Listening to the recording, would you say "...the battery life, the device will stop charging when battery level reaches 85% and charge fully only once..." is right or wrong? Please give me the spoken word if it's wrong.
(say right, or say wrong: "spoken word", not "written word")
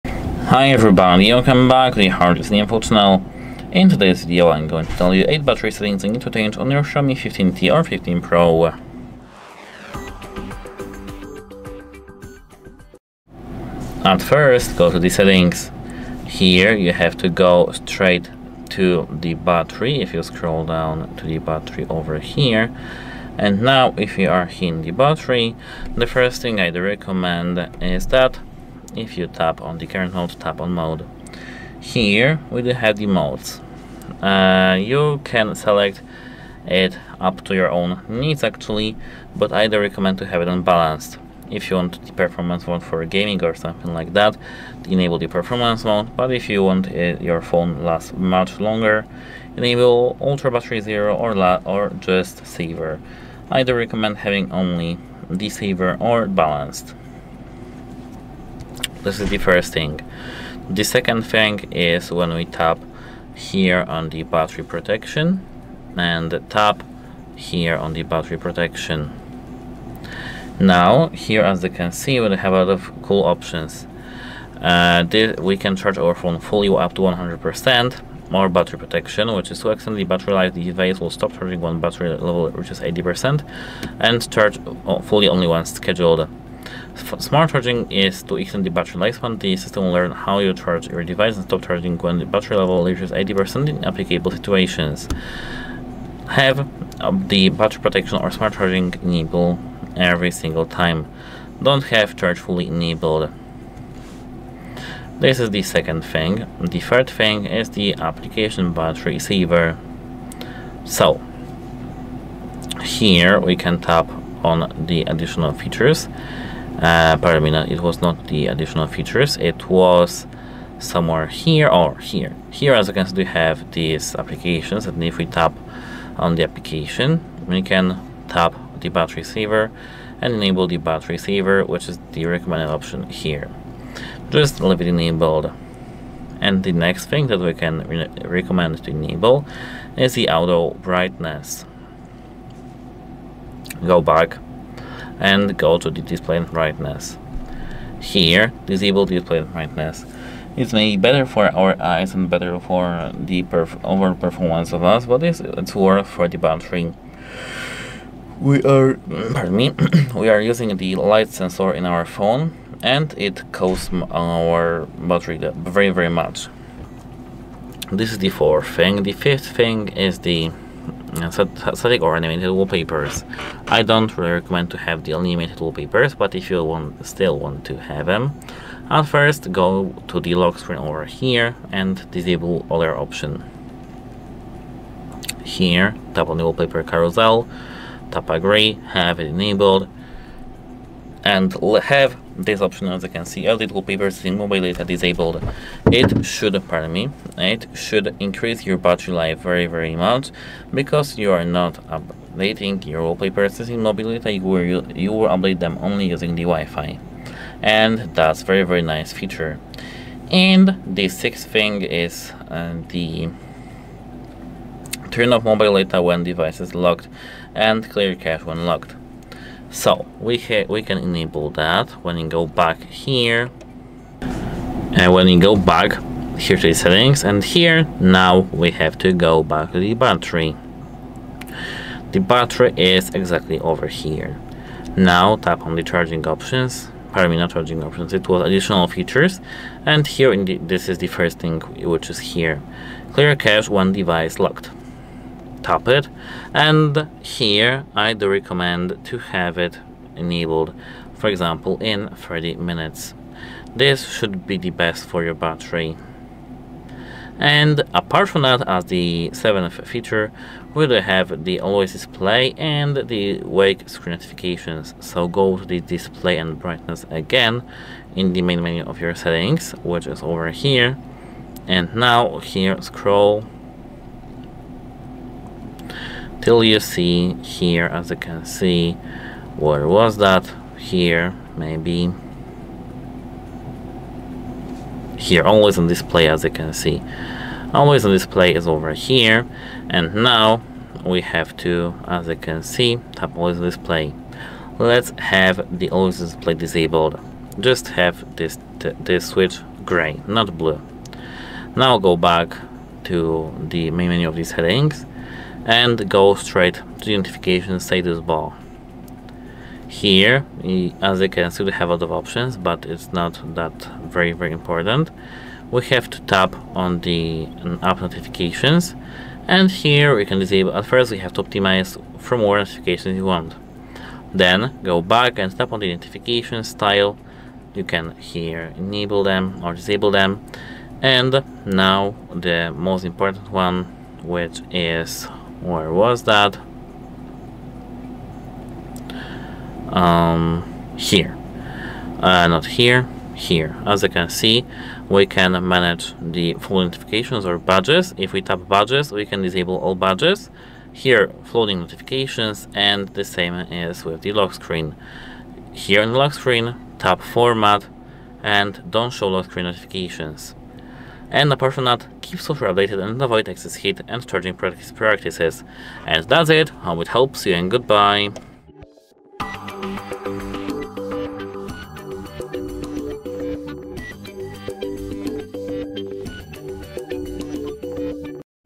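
wrong: "80", not "85".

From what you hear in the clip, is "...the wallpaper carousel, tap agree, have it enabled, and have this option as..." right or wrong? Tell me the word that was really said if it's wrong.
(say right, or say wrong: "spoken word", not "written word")
right.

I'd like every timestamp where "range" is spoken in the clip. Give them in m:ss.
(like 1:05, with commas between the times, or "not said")
not said.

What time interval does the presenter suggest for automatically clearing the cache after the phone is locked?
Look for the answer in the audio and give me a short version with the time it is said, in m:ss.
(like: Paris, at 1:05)
30 minutes, at 4:12.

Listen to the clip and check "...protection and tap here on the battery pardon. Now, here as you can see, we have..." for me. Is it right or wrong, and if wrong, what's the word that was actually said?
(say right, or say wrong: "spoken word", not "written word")
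wrong: "protection", not "pardon".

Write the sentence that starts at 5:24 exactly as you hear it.
Then go back and tap on the notification style.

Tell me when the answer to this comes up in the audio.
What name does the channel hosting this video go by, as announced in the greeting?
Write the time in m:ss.
0:02.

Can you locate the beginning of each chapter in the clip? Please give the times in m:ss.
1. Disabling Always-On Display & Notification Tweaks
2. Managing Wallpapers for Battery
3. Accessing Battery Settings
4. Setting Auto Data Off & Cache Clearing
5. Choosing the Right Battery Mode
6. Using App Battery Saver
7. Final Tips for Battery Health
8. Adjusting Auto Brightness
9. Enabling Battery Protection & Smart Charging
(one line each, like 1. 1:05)
1. 4:25
2. 2:49
3. 0:12
4. 3:30
5. 0:28
6. 1:46
7. 5:40
8. 2:16
9. 0:53.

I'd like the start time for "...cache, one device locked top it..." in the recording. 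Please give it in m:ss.
4:03.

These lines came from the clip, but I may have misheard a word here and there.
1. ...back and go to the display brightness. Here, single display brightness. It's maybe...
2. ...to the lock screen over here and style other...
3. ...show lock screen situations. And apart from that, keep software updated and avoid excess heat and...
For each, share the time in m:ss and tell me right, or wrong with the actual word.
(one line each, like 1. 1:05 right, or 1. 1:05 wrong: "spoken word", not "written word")
1. 2:24 wrong: "disable", not "single"
2. 3:00 wrong: "disable", not "style"
3. 5:59 wrong: "notifications", not "situations".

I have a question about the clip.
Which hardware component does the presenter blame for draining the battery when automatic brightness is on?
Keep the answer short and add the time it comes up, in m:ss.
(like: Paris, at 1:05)
light sensor, at 2:40.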